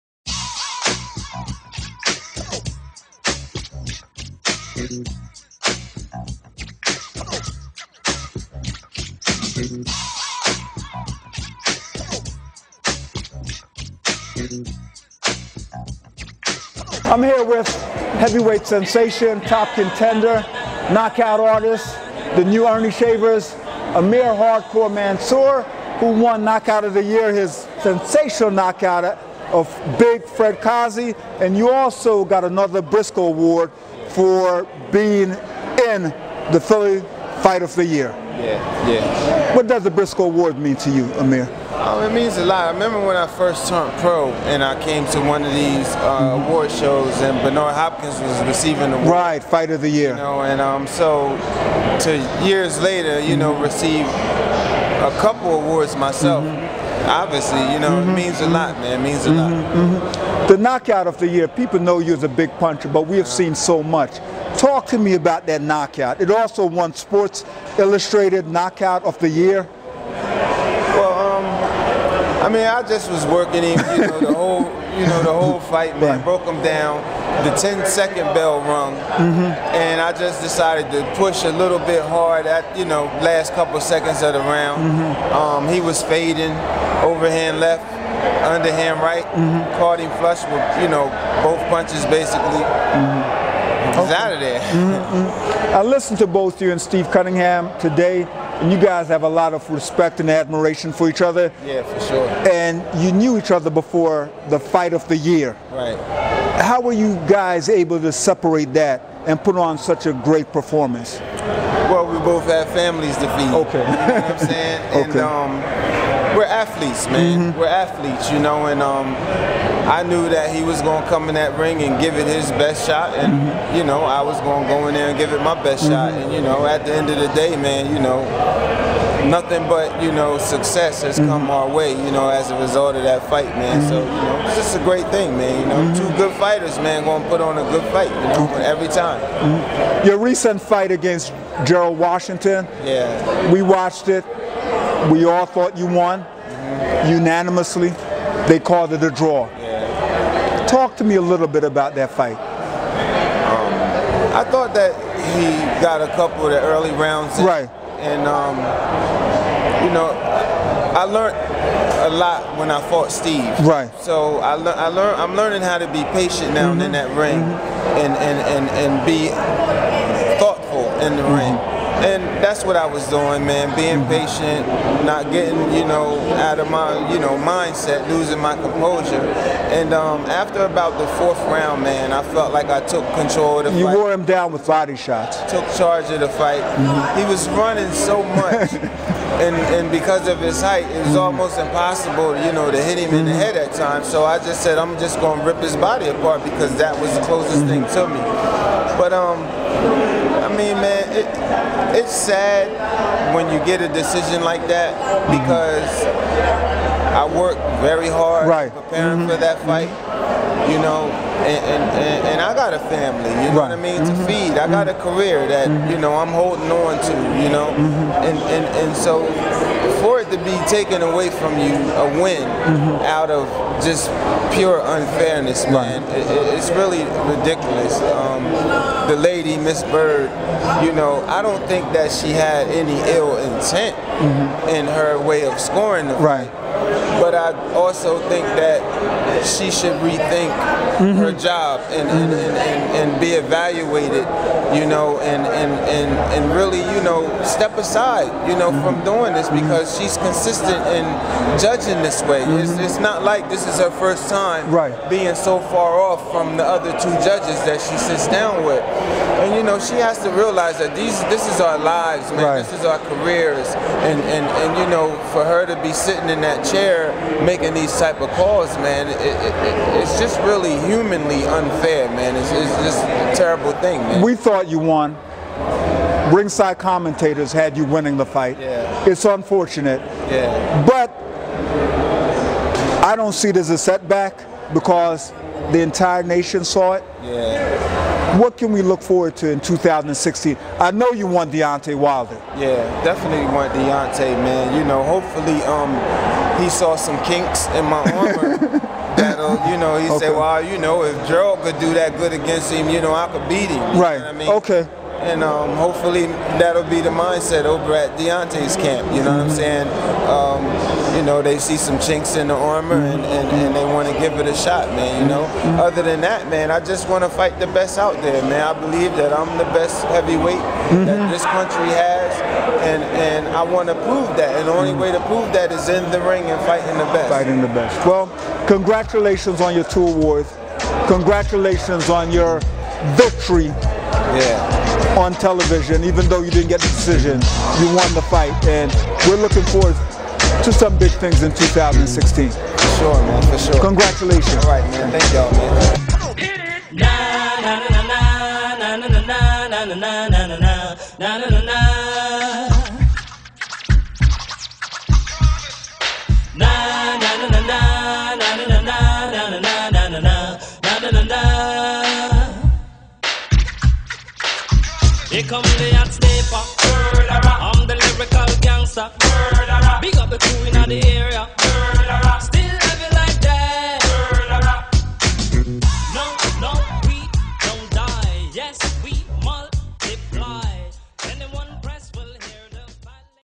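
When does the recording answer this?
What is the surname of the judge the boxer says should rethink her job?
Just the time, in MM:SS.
03:49.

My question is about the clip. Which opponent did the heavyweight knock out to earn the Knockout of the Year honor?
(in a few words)
Big Fred Kassi.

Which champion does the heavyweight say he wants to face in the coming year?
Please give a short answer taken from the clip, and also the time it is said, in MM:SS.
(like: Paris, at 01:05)
Deontay Wilder, at 04:51.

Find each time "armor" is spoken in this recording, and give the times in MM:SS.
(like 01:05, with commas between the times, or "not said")
04:58, 05:12.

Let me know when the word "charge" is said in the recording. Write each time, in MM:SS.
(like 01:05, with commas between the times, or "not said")
03:05.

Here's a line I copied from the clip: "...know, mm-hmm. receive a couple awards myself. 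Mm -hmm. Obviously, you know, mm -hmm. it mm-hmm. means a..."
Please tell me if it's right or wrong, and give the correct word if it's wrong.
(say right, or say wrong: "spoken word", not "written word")
right.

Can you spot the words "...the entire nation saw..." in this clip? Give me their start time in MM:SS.
04:45.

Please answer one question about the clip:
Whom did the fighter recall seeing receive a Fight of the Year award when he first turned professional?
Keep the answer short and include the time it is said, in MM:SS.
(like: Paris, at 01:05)
Bernard Hopkins, at 00:47.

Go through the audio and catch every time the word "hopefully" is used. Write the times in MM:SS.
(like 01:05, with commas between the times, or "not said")
04:55, 05:05.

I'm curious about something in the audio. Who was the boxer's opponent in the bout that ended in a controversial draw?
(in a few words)
Gerald Washington.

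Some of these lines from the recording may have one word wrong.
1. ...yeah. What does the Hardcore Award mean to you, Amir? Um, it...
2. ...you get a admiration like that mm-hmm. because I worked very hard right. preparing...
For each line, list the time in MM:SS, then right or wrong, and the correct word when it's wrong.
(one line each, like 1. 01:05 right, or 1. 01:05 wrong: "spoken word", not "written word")
1. 00:38 wrong: "Briscoe", not "Hardcore"
2. 03:23 wrong: "decision", not "admiration".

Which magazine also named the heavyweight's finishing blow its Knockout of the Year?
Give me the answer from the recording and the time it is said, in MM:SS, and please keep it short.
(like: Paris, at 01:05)
Sports Illustrated, at 01:06.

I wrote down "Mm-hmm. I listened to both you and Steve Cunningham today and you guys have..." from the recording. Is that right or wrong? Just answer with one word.
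right.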